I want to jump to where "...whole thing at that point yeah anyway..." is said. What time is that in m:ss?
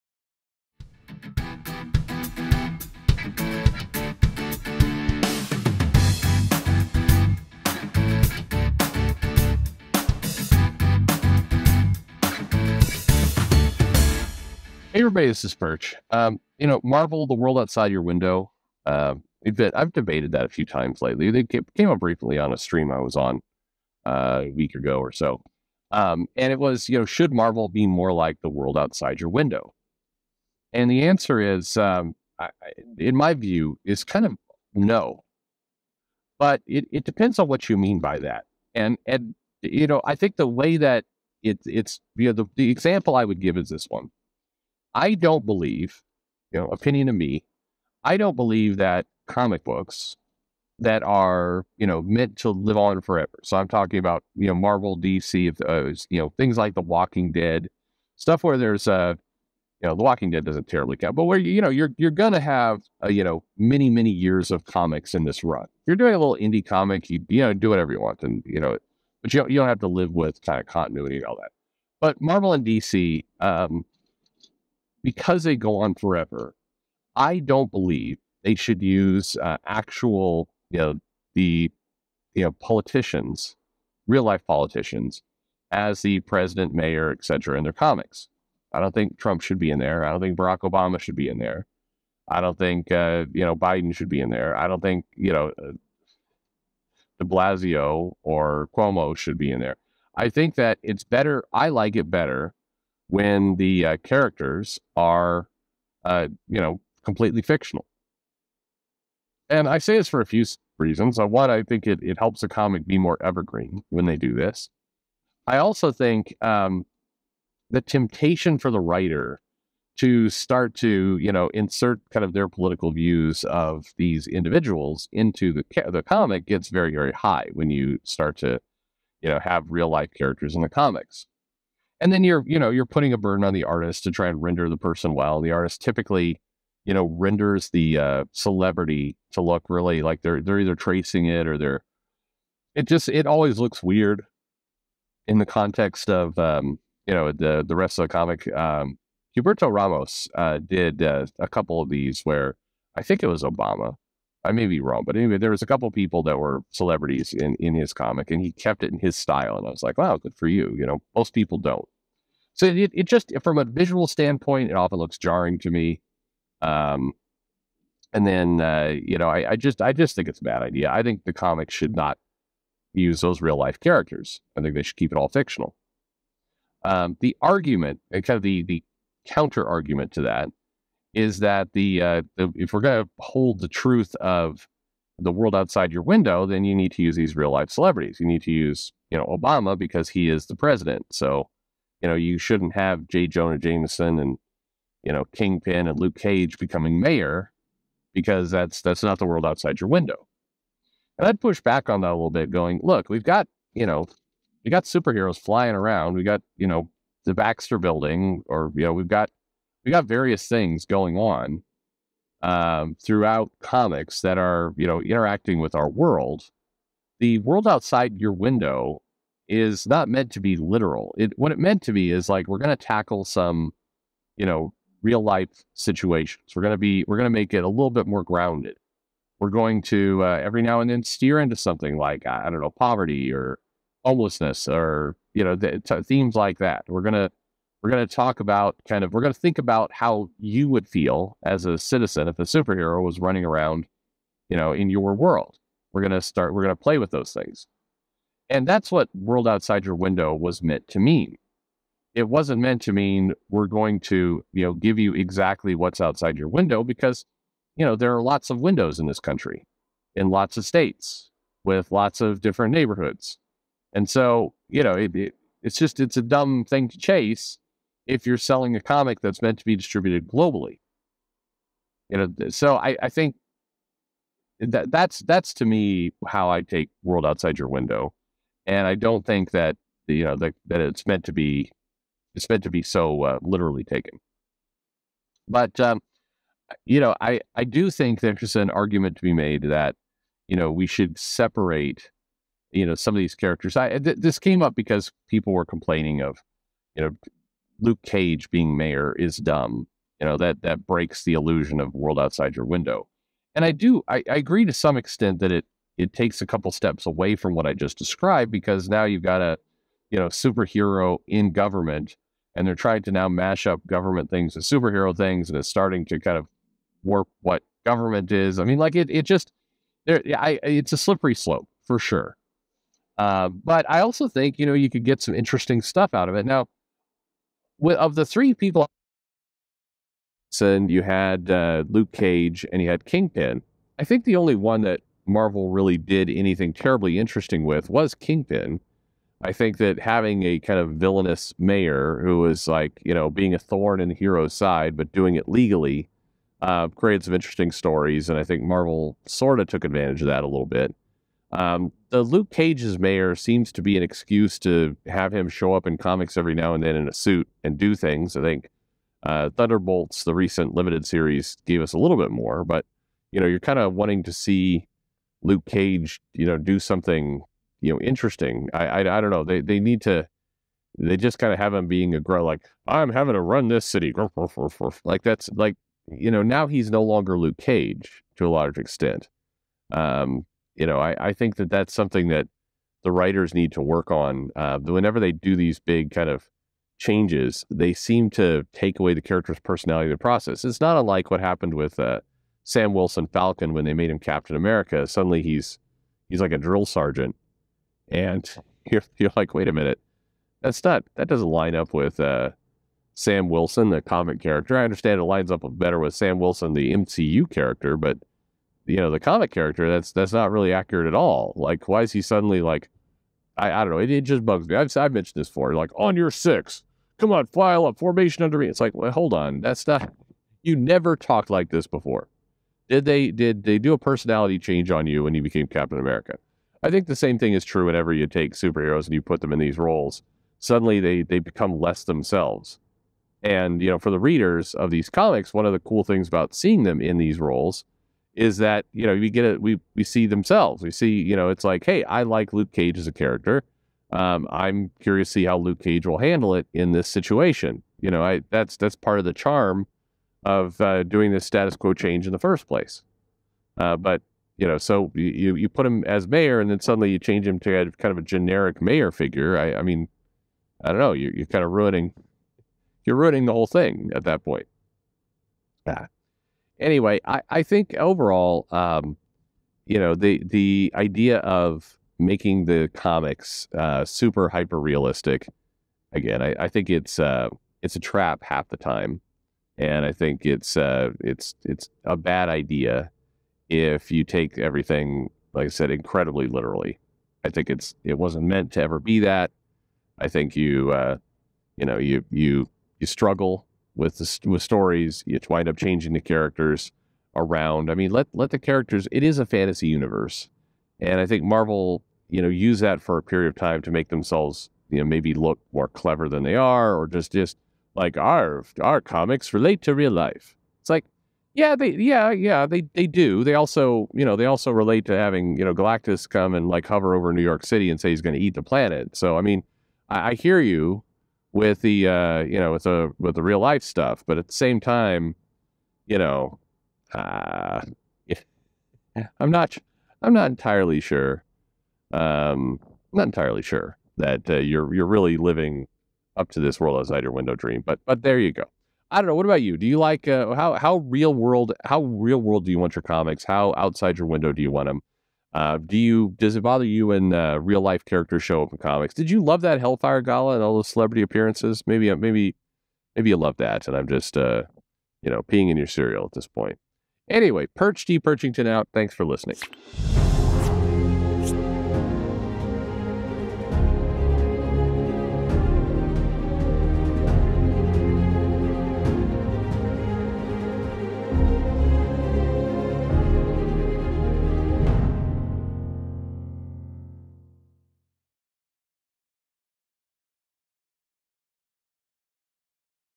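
7:43.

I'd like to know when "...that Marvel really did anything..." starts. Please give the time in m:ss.
5:34.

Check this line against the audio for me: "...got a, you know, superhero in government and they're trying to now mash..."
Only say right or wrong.
right.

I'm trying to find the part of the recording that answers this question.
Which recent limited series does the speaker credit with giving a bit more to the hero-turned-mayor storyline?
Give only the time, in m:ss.
5:59.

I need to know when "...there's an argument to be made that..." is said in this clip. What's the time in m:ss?
4:48.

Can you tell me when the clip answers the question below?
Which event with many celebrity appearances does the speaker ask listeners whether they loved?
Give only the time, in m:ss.
9:09.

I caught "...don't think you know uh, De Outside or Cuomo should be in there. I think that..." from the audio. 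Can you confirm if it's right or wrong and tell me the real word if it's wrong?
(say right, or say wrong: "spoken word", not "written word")
wrong: "Blasio", not "Outside".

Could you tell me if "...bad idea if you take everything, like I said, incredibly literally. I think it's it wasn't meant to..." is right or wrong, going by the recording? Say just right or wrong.
right.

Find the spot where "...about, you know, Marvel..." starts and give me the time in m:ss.
0:53.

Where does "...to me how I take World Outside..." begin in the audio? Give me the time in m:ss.
4:35.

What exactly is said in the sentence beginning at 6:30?
It's not unlike what happened with uh, Sam Wilson Falcon when they made him Captain America.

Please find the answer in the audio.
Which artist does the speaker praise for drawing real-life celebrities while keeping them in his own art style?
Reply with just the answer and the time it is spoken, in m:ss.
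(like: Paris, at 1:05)
Humberto Ramos, at 2:29.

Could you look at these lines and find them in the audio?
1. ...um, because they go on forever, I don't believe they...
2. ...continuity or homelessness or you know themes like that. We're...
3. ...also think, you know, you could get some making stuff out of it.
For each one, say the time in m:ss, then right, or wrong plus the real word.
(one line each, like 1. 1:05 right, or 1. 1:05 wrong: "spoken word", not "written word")
1. 1:13 right
2. 3:52 wrong: "poverty", not "continuity"
3. 5:24 wrong: "interesting", not "making".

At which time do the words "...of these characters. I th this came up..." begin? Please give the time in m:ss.
4:53.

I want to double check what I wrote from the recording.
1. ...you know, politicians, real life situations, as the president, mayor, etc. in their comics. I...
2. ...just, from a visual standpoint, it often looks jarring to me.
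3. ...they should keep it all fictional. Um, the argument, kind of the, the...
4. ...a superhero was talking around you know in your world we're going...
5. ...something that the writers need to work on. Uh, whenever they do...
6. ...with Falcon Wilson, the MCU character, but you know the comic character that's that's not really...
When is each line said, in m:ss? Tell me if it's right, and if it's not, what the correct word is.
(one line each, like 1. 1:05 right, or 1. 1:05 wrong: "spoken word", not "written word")
1. 1:22 wrong: "politicians", not "situations"
2. 2:43 right
3. 2:54 right
4. 4:02 wrong: "running", not "talking"
5. 6:21 right
6. 6:45 wrong: "Sam", not "Falcon".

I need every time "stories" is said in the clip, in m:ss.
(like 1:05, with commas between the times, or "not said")
5:47, 8:14.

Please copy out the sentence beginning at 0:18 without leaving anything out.
Uh, I've debated that a few times lately.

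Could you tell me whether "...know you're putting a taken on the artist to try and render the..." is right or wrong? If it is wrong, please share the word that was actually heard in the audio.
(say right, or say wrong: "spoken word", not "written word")
wrong: "burden", not "taken".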